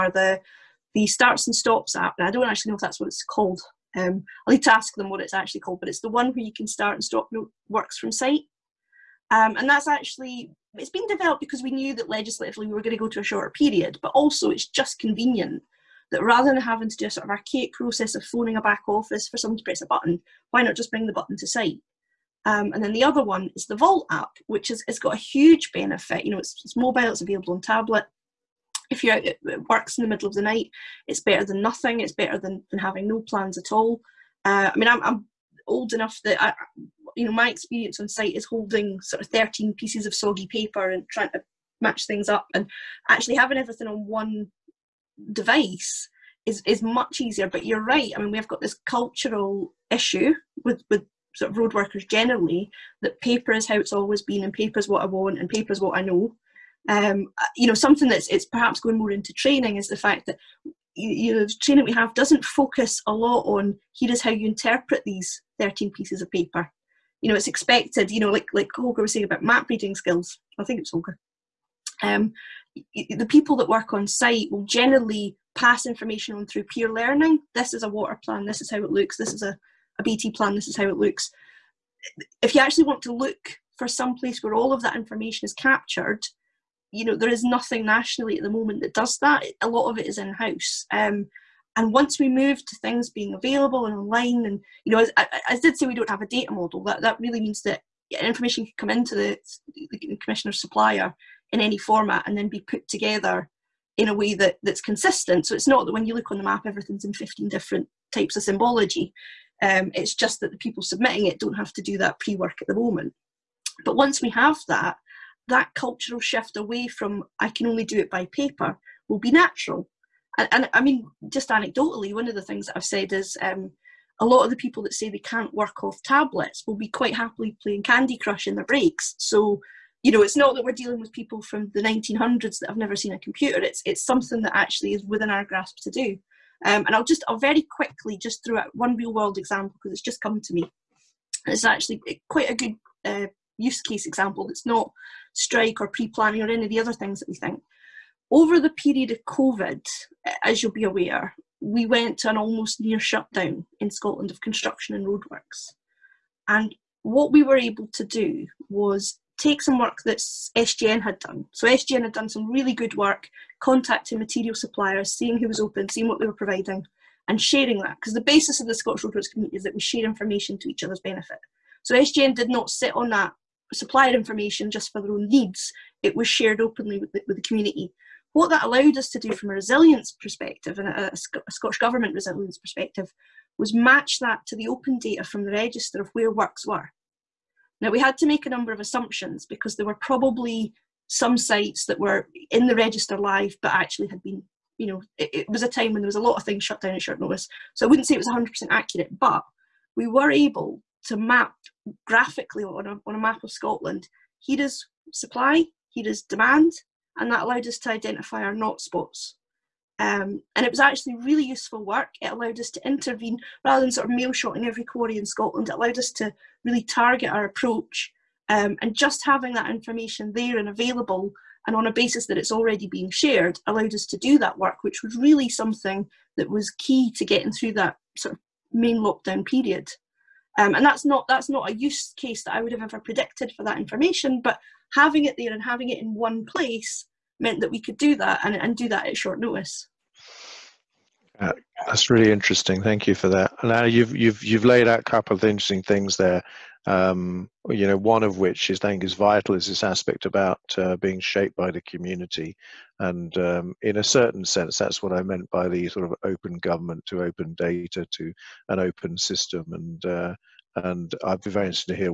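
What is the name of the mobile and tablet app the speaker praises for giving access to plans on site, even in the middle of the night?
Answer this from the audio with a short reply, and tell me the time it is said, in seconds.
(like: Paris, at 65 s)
Vault app, at 23 s.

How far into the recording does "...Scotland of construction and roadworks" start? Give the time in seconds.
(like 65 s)
153 s.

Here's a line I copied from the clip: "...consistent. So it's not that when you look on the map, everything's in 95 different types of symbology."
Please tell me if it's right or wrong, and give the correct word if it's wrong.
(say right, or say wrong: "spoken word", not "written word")
wrong: "15", not "95".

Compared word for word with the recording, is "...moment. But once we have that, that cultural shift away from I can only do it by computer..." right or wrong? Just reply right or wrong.
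wrong.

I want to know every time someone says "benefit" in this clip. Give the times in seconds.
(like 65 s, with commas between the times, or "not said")
25 s, 170 s.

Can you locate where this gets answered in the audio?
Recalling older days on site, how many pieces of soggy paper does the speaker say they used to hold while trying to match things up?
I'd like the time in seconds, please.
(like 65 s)
39 s.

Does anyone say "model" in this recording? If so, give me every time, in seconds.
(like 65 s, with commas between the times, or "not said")
96 s.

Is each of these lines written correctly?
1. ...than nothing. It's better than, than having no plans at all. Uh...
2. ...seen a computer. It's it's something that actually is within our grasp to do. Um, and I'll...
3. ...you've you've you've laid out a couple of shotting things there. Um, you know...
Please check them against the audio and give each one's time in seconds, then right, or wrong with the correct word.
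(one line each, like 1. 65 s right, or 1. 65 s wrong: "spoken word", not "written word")
1. 31 s right
2. 132 s right
3. 243 s wrong: "interesting", not "shotting".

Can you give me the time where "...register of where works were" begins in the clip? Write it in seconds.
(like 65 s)
185 s.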